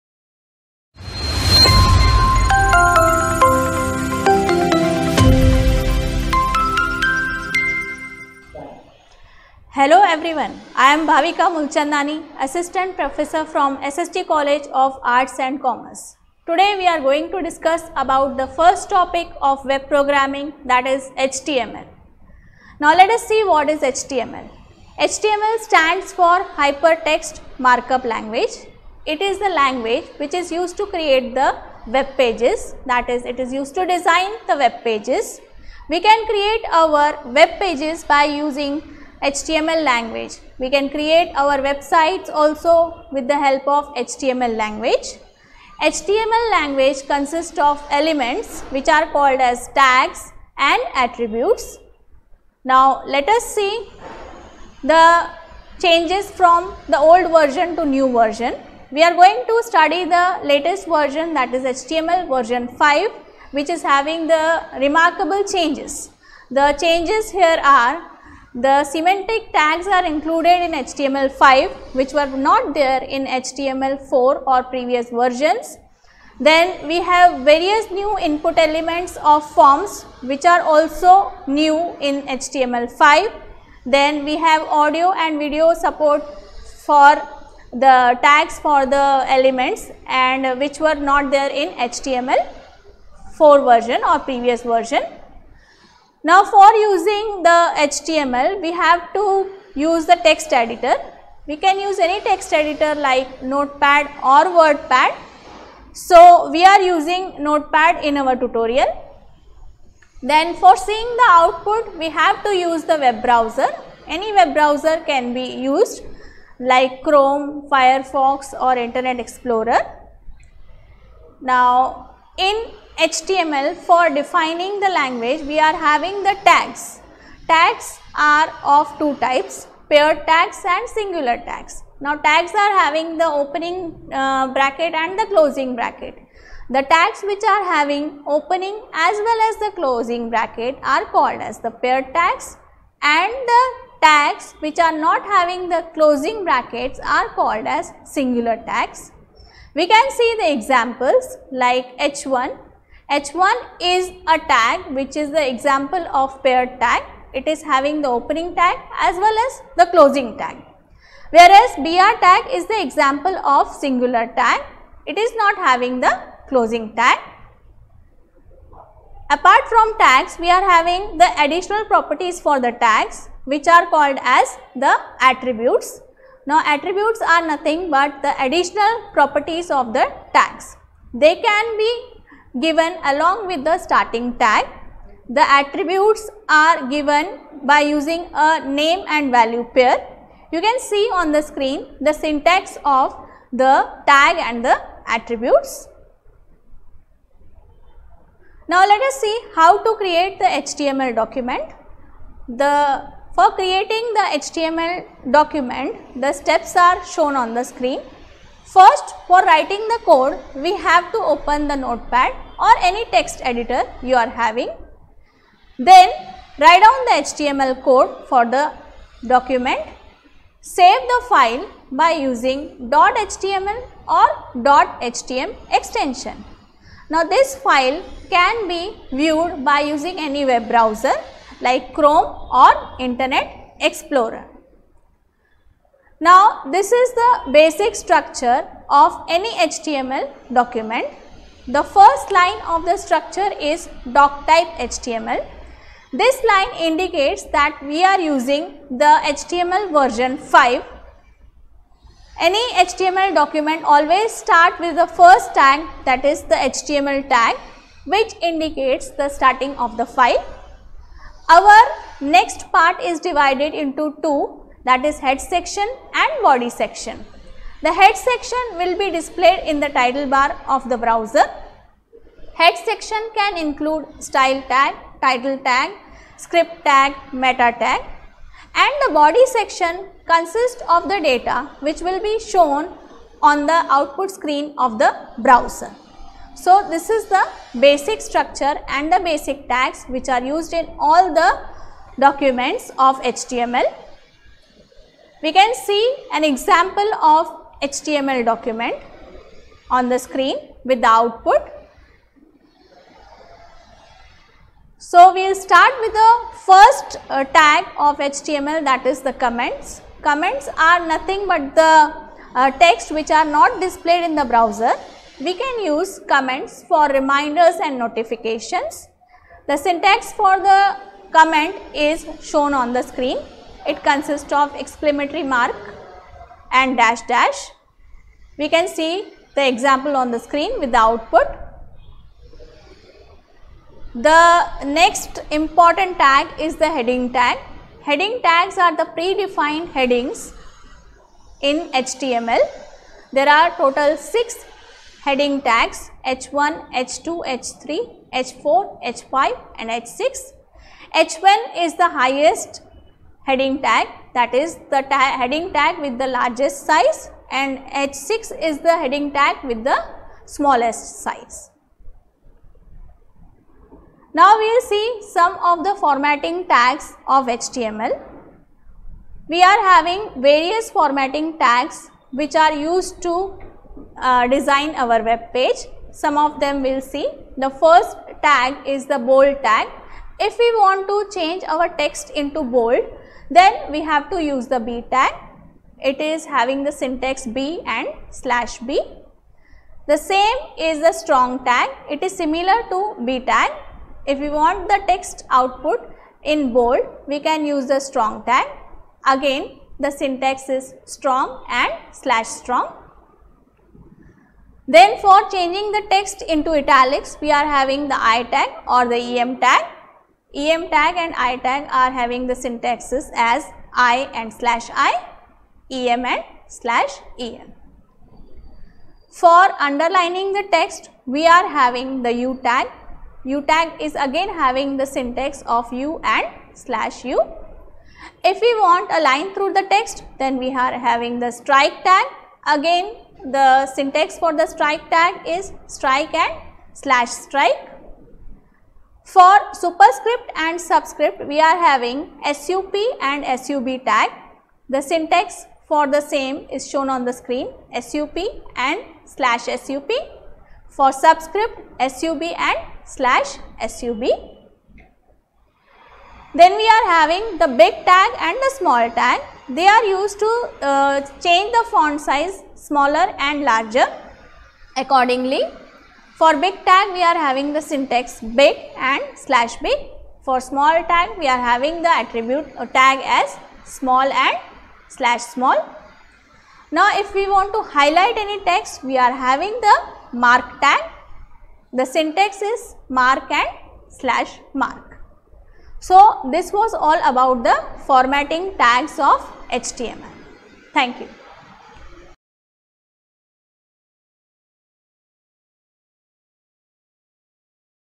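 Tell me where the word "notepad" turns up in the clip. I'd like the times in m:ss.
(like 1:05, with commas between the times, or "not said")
1:43, 1:47, 3:31.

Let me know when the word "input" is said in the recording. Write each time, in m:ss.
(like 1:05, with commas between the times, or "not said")
1:18.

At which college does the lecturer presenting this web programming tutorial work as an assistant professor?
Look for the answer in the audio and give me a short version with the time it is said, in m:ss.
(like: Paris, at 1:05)
SST College of Arts and Commerce, at 0:13.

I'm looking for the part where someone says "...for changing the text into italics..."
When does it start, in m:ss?
6:45.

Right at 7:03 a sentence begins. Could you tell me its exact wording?
U tag is again having the syntax of U and slash U.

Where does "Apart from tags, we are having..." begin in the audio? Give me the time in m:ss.
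2:49.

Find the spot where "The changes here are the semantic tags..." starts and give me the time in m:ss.
1:06.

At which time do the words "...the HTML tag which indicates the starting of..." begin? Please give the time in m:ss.
4:16.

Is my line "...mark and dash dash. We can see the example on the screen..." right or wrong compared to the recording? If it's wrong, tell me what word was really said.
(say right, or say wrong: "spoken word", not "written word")
right.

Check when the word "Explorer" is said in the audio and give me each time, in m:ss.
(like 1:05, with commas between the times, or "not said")
1:59, 3:53.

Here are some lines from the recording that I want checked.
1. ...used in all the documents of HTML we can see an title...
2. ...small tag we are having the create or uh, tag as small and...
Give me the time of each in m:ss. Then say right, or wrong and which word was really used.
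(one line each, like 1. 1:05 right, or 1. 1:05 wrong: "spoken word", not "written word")
1. 4:50 wrong: "example", not "title"
2. 7:50 wrong: "attribute", not "create".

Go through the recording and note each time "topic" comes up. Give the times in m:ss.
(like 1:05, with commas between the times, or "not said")
0:18.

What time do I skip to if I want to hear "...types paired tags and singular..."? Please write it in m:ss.
2:09.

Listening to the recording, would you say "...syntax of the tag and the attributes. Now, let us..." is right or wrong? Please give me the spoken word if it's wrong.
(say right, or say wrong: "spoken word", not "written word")
right.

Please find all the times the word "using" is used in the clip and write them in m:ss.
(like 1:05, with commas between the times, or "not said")
0:38, 1:36, 1:46, 3:07, 3:42, 3:49, 4:08.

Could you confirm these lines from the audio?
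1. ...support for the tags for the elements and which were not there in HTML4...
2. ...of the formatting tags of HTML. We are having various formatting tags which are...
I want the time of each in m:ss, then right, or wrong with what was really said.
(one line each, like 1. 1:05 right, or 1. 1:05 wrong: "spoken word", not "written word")
1. 1:25 right
2. 6:05 right.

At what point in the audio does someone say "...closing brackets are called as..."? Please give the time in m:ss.
2:25.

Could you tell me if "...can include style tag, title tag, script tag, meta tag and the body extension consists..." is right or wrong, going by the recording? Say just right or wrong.
wrong.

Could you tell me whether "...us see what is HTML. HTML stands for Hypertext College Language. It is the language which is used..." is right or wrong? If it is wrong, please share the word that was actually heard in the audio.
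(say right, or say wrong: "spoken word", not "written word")
wrong: "Markup", not "College".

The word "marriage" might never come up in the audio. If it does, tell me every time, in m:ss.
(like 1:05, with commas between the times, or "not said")
not said.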